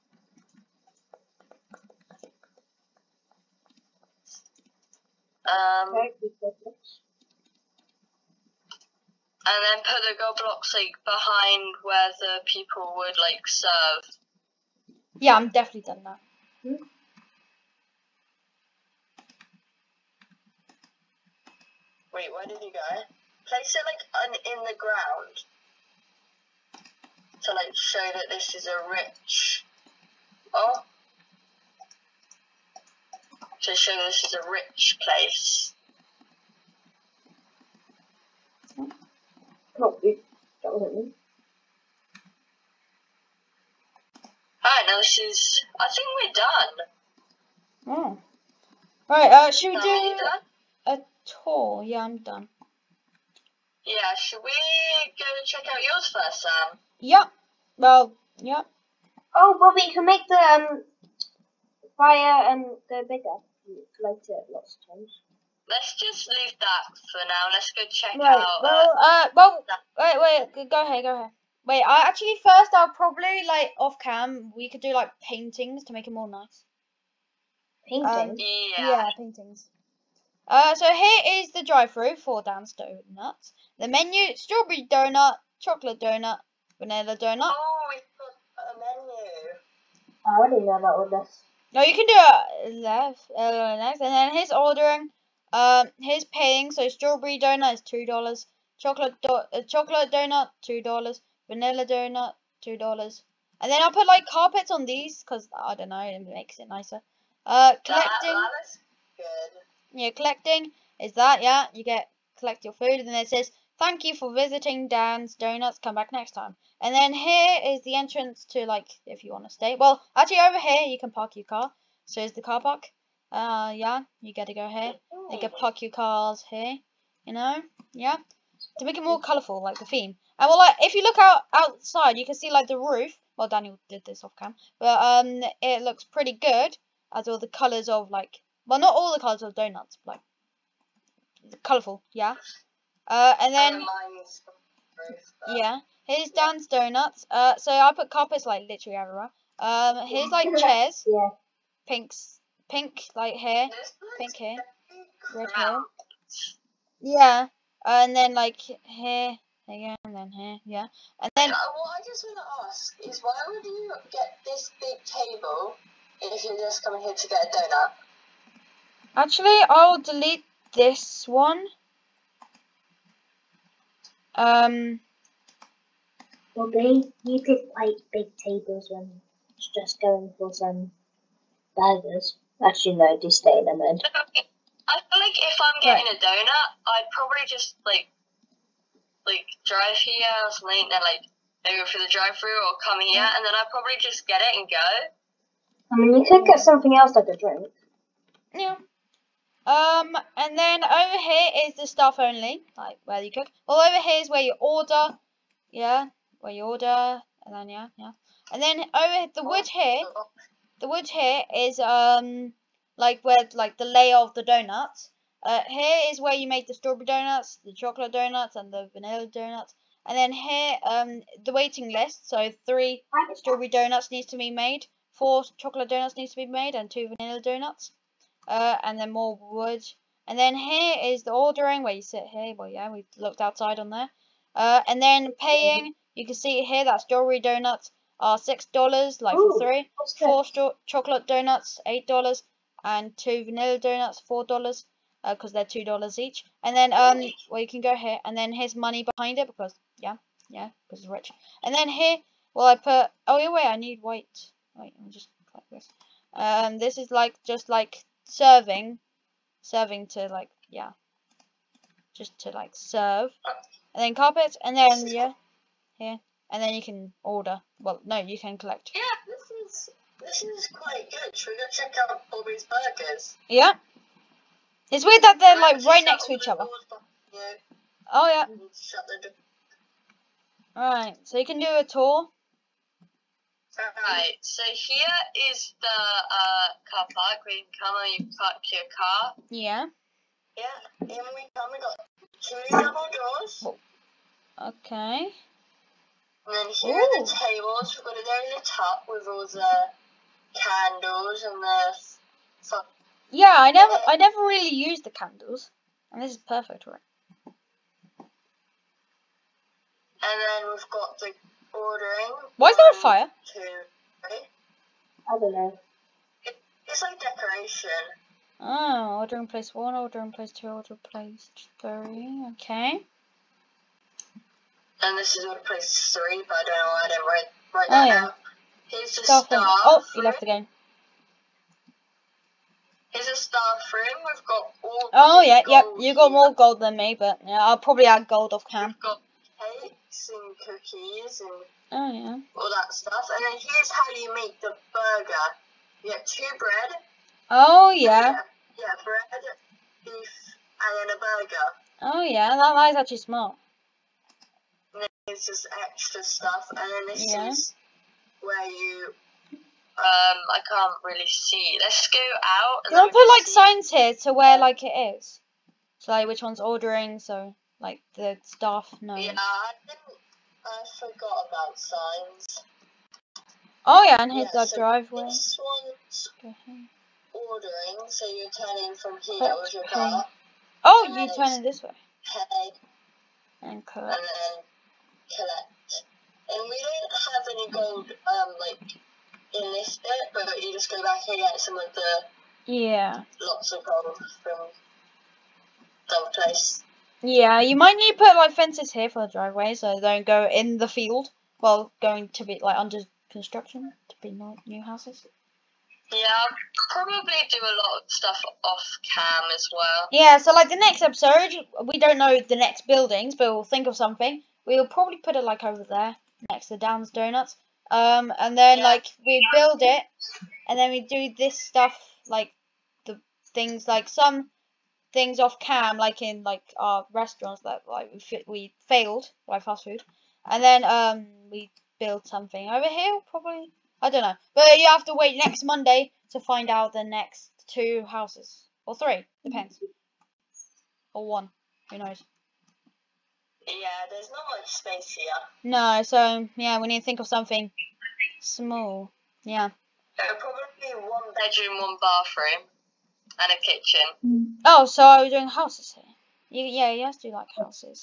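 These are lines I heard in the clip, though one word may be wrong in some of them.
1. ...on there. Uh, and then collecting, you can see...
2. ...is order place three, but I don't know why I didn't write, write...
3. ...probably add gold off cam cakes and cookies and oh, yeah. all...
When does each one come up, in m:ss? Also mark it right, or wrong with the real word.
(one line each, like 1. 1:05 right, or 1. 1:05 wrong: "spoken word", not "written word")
1. 3:53 wrong: "paying", not "collecting"
2. 5:25 right
3. 5:37 right.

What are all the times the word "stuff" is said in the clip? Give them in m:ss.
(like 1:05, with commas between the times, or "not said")
3:21, 5:42, 5:56, 6:48, 7:01.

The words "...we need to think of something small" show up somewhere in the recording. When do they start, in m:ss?
7:26.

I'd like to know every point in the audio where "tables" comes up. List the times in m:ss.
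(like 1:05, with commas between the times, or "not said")
2:45, 2:58, 4:57.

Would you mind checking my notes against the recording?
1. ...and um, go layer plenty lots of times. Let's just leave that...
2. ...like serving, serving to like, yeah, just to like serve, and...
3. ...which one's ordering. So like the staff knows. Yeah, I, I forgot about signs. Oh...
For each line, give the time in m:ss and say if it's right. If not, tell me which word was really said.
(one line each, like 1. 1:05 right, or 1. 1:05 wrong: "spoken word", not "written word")
1. 1:02 wrong: "bigger", not "layer"
2. 4:17 right
3. 6:06 right.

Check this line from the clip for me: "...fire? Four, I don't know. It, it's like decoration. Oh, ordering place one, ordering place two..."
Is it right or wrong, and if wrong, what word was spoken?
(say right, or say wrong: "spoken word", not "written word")
wrong: "Two", not "Four".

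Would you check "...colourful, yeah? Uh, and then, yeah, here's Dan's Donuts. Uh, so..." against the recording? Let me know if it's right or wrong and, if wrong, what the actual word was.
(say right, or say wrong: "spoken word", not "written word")
right.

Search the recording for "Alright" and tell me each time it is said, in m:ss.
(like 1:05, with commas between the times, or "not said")
0:44, 0:49, 4:40.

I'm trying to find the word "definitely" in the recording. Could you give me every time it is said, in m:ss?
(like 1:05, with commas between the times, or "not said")
0:15.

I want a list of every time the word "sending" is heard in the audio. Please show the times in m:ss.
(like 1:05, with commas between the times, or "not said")
not said.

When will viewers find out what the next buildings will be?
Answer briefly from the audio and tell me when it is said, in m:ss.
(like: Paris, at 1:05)
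Next Monday, at 7:15.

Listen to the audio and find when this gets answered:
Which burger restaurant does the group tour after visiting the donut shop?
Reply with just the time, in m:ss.
4:32.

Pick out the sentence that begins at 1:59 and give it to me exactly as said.
Well, actually, over here, you can park your car.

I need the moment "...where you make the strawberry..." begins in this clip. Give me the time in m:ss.
3:36.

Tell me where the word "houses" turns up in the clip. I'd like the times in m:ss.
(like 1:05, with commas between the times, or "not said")
6:44, 7:18, 7:35.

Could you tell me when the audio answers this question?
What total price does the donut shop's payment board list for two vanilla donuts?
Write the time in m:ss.
4:04.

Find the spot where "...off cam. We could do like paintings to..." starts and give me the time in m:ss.
1:13.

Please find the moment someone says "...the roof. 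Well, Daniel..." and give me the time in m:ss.
2:12.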